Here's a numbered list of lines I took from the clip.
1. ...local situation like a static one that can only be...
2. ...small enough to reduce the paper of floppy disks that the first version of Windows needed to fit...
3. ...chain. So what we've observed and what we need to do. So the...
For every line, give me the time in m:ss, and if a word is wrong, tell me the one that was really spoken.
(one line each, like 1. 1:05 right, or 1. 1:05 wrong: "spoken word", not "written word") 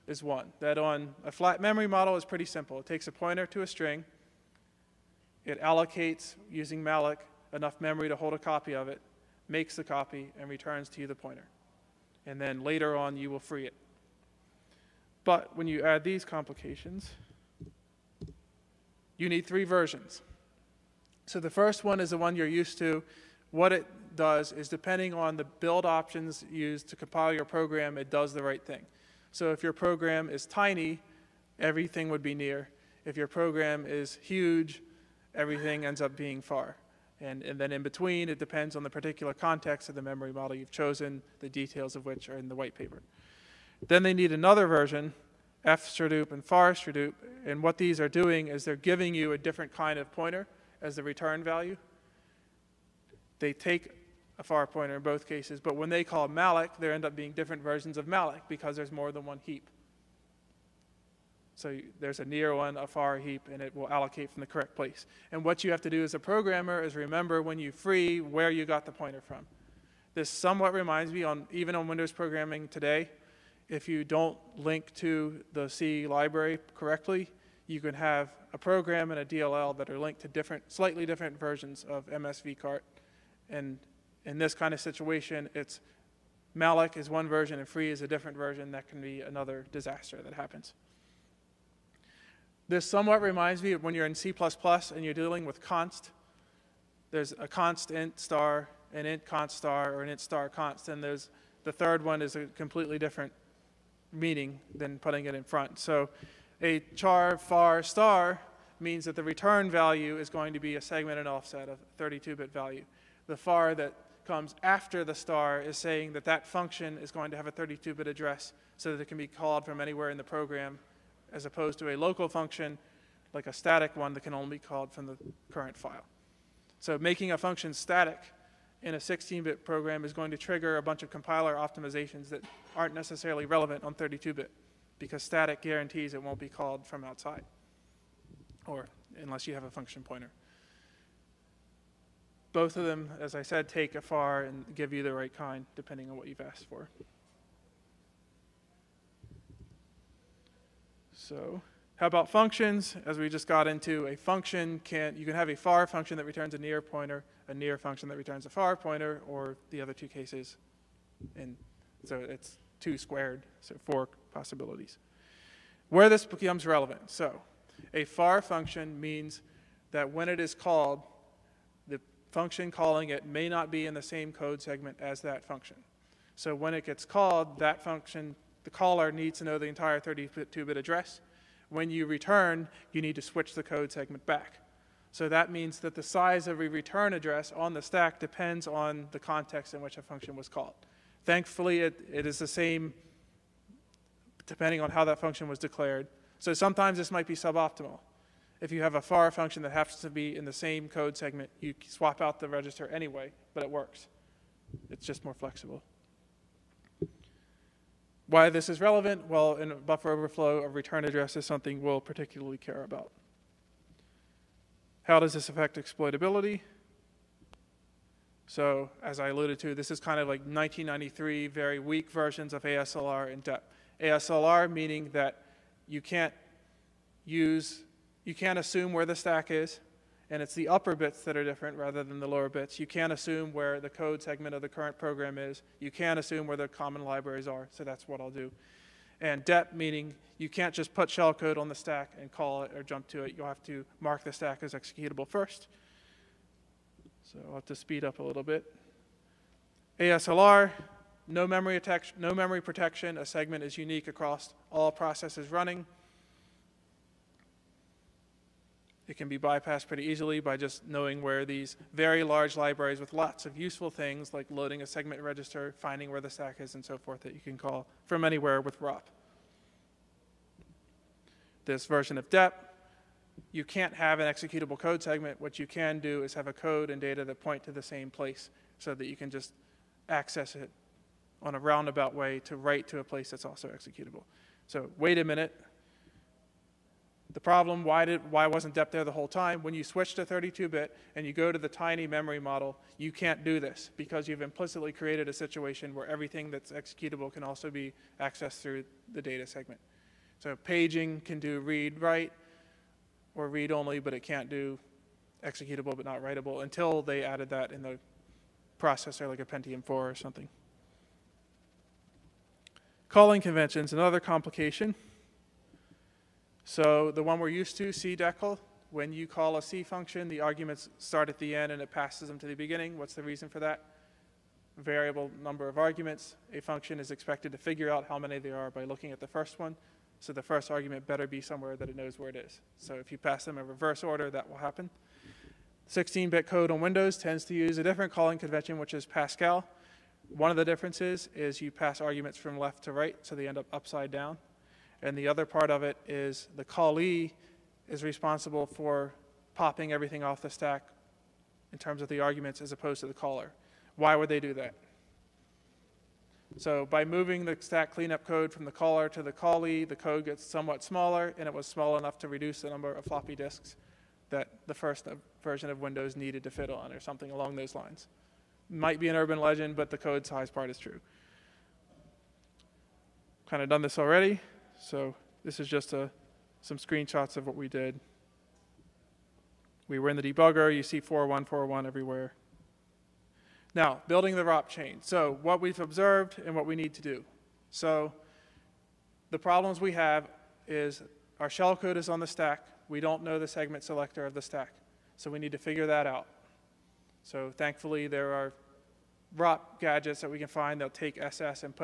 1. 2:01 wrong: "function", not "situation"
2. 6:01 wrong: "number", not "paper"
3. 6:24 right.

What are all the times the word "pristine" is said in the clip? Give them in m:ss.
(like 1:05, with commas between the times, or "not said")
not said.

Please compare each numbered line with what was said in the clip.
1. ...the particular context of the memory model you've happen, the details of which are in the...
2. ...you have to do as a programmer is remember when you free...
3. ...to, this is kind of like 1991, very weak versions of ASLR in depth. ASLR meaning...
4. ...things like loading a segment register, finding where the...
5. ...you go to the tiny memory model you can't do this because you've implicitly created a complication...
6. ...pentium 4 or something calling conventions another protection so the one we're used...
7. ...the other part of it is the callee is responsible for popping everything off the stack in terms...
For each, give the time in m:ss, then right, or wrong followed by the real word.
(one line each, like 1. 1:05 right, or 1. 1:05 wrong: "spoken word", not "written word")
1. 0:38 wrong: "chosen", not "happen"
2. 1:05 right
3. 3:39 wrong: "1993", not "1991"
4. 4:23 right
5. 4:51 wrong: "situation", not "complication"
6. 5:09 wrong: "complication", not "protection"
7. 5:45 right.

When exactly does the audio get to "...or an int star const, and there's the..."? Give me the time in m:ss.
1:39.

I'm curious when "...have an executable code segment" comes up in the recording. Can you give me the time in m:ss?
4:33.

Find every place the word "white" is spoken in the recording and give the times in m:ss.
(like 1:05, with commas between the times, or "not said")
0:42.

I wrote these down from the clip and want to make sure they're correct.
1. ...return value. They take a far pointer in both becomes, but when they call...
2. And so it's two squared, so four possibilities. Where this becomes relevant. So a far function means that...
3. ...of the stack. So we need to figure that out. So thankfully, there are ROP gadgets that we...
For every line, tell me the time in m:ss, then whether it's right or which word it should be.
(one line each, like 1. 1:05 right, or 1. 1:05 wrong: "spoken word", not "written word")
1. 0:51 wrong: "cases", not "becomes"
2. 2:41 right
3. 6:34 right.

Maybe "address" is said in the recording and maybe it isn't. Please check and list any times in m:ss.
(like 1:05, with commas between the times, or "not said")
1:58, 3:00, 3:07, 3:31.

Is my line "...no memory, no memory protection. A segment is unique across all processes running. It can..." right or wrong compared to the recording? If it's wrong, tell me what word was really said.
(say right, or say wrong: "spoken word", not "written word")
right.